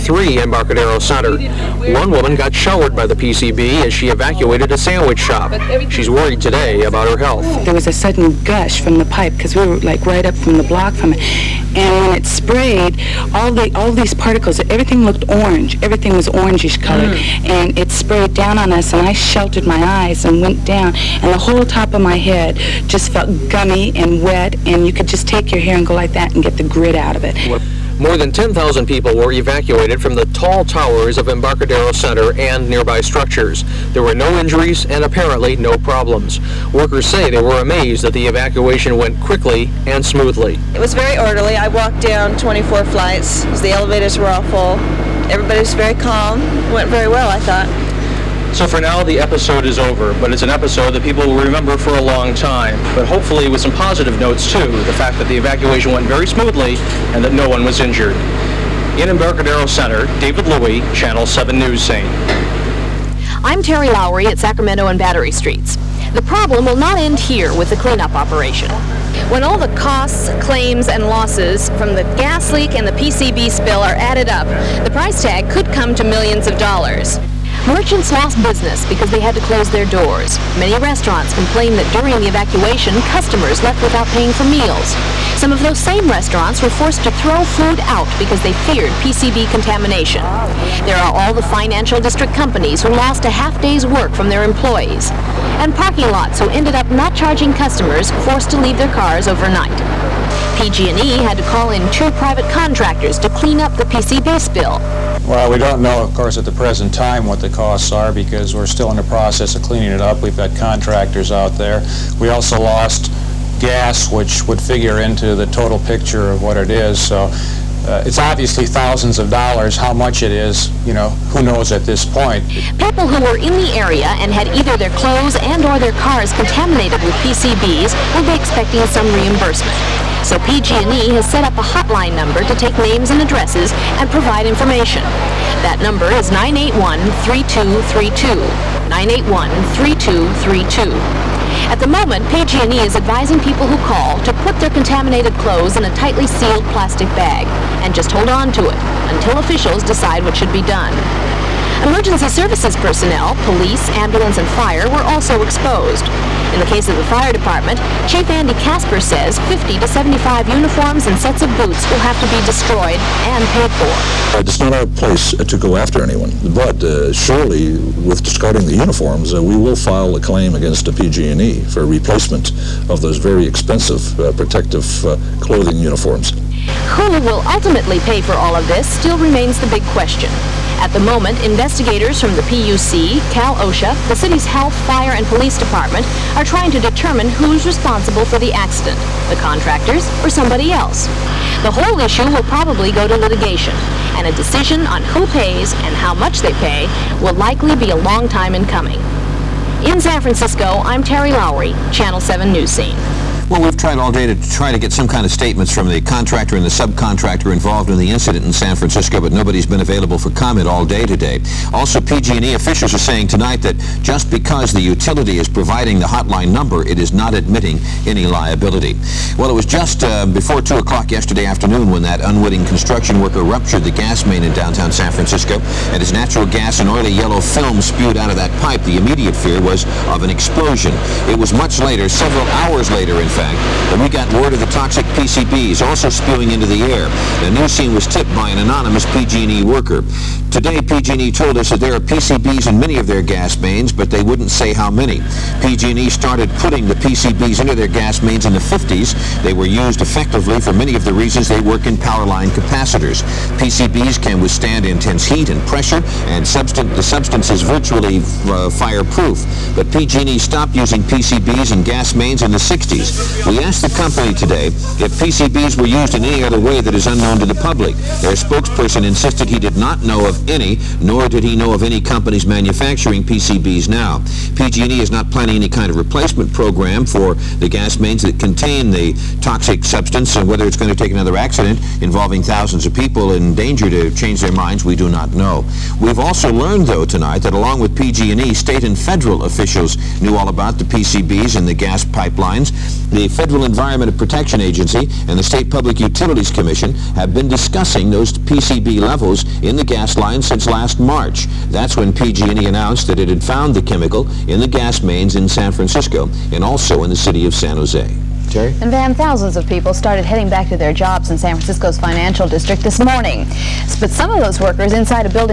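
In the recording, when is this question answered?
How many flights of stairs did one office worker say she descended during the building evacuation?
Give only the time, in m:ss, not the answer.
0:42.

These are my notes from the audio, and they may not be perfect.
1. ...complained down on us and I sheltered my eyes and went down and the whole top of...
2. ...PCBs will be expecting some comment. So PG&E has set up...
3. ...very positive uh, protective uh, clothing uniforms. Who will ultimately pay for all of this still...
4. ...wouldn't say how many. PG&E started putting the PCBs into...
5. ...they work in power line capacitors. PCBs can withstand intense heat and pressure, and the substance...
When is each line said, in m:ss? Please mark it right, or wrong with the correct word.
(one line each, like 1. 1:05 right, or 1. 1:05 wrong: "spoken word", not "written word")
1. 0:17 wrong: "sprayed", not "complained"
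2. 2:07 wrong: "reimbursement", not "comment"
3. 2:53 wrong: "expensive", not "positive"
4. 4:04 right
5. 4:11 right.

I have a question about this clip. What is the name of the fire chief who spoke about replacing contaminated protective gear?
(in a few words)
Andy Casper.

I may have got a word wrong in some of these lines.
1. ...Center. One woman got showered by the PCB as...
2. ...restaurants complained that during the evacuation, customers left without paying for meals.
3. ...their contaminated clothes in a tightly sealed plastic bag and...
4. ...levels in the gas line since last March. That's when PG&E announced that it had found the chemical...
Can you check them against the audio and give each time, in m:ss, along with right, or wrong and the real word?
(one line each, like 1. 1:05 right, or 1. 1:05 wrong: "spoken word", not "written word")
1. 0:00 right
2. 1:20 right
3. 2:24 right
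4. 4:58 right.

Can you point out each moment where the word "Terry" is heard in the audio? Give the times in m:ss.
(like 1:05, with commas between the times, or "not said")
1:03, 3:21.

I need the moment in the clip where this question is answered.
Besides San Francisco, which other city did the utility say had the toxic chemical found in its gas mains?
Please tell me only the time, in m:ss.
5:07.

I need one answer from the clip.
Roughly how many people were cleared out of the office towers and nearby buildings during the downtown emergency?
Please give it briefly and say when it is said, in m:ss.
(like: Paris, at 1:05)
10,000, at 0:28.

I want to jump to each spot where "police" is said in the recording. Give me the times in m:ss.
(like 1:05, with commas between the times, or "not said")
2:33, 3:05.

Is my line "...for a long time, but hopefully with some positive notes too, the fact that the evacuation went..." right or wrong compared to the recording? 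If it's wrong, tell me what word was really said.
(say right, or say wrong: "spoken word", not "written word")
right.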